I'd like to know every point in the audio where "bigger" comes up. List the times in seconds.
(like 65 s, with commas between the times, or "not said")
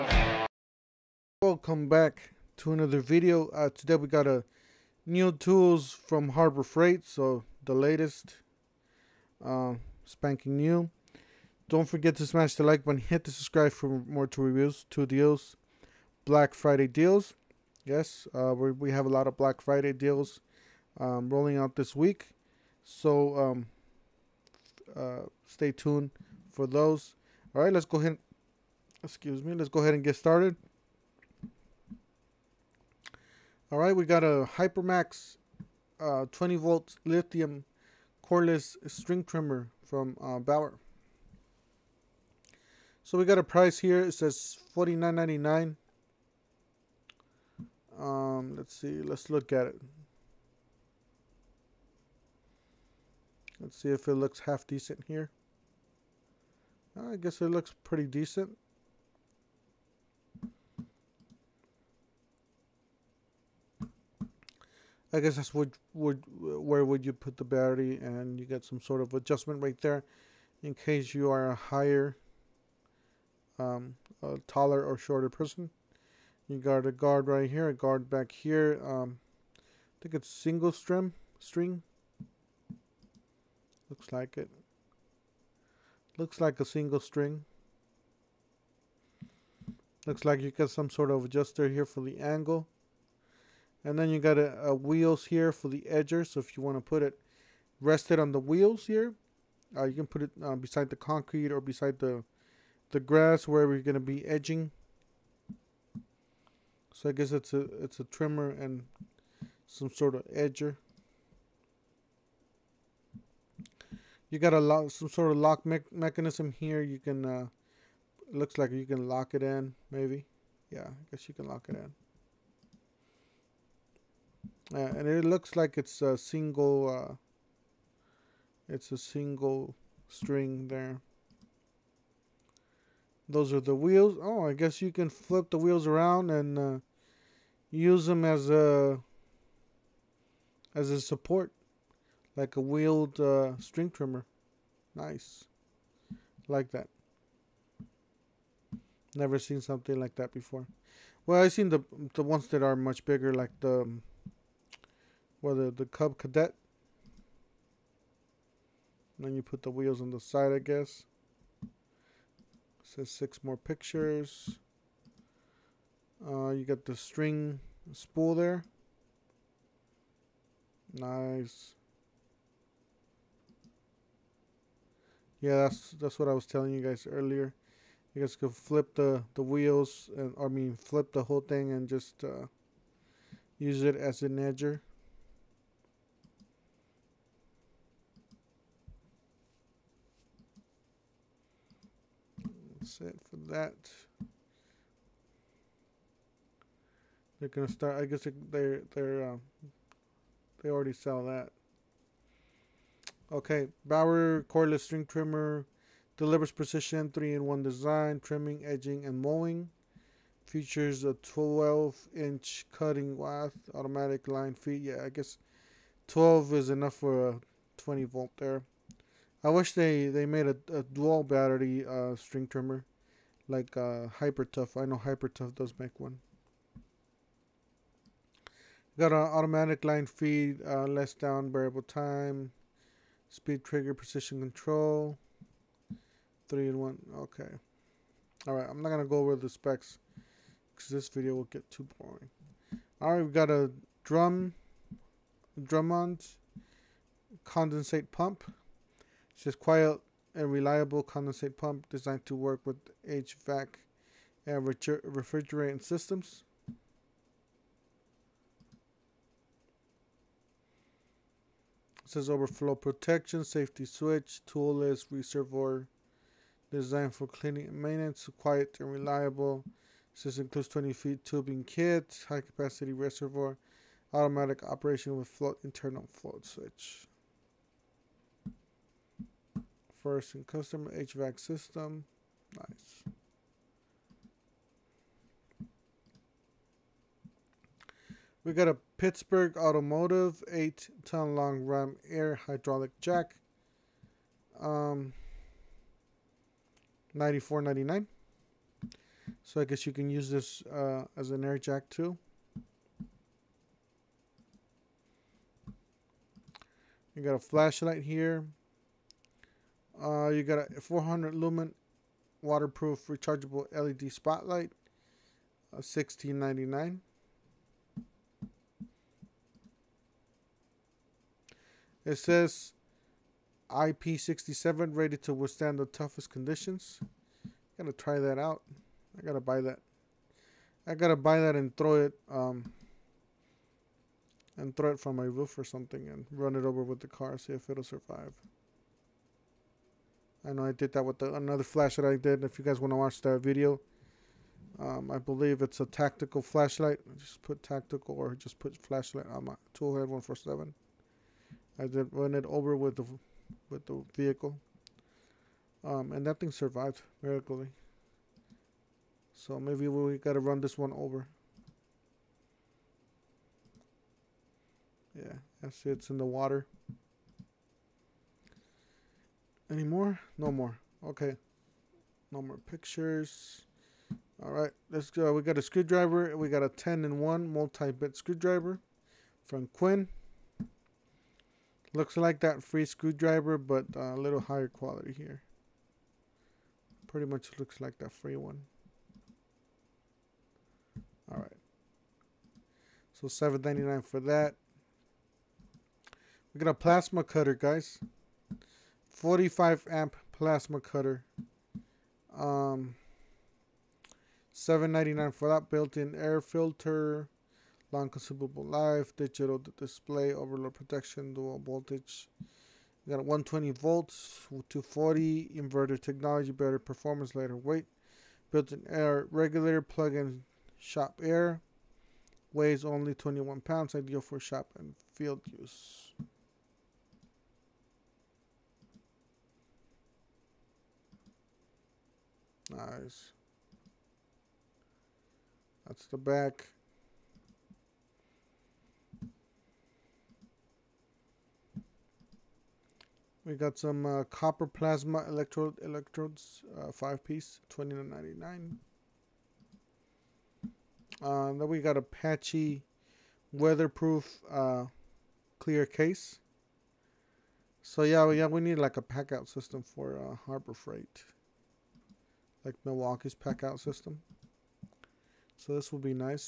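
153 s.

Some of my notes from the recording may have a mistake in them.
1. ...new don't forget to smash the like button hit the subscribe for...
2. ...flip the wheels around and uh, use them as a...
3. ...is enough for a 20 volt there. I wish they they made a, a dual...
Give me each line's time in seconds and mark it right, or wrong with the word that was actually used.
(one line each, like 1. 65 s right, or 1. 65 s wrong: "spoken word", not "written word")
1. 10 s right
2. 135 s right
3. 216 s right.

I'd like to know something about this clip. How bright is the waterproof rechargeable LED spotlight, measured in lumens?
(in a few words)
400 lumens.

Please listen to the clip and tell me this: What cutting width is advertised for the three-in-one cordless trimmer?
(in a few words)
12-inch.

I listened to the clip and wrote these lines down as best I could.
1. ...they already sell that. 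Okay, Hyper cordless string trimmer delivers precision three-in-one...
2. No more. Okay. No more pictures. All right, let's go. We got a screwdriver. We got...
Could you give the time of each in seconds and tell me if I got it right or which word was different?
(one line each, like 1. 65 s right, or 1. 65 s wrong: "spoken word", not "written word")
1. 200 s wrong: "Bauer", not "Hyper"
2. 370 s right.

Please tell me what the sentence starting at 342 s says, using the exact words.
If you guys want to watch that video, um, I believe it's a tactical flashlight.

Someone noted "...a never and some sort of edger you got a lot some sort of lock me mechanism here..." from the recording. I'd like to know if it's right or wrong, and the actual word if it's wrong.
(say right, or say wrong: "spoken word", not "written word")
wrong: "trimmer", not "never".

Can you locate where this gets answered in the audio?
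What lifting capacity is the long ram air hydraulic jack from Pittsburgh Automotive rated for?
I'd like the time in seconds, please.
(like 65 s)
290 s.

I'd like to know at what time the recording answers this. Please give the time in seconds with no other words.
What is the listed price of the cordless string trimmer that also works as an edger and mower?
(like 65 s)
44 s.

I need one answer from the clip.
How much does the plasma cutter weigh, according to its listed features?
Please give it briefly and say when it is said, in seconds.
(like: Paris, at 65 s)
21 pounds, at 423 s.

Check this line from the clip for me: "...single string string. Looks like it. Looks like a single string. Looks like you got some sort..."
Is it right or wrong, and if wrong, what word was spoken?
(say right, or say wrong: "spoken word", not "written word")
right.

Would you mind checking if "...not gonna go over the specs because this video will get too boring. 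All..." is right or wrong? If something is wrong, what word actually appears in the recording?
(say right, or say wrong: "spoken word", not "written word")
right.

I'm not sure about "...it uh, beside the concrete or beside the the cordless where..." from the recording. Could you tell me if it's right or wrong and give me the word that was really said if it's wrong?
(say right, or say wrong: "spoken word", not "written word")
wrong: "grass", not "cordless".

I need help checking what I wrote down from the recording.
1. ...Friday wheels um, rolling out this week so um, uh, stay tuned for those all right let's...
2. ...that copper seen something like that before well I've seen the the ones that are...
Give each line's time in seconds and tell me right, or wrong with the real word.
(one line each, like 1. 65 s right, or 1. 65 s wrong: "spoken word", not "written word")
1. 19 s wrong: "deals", not "wheels"
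2. 146 s wrong: "never", not "copper".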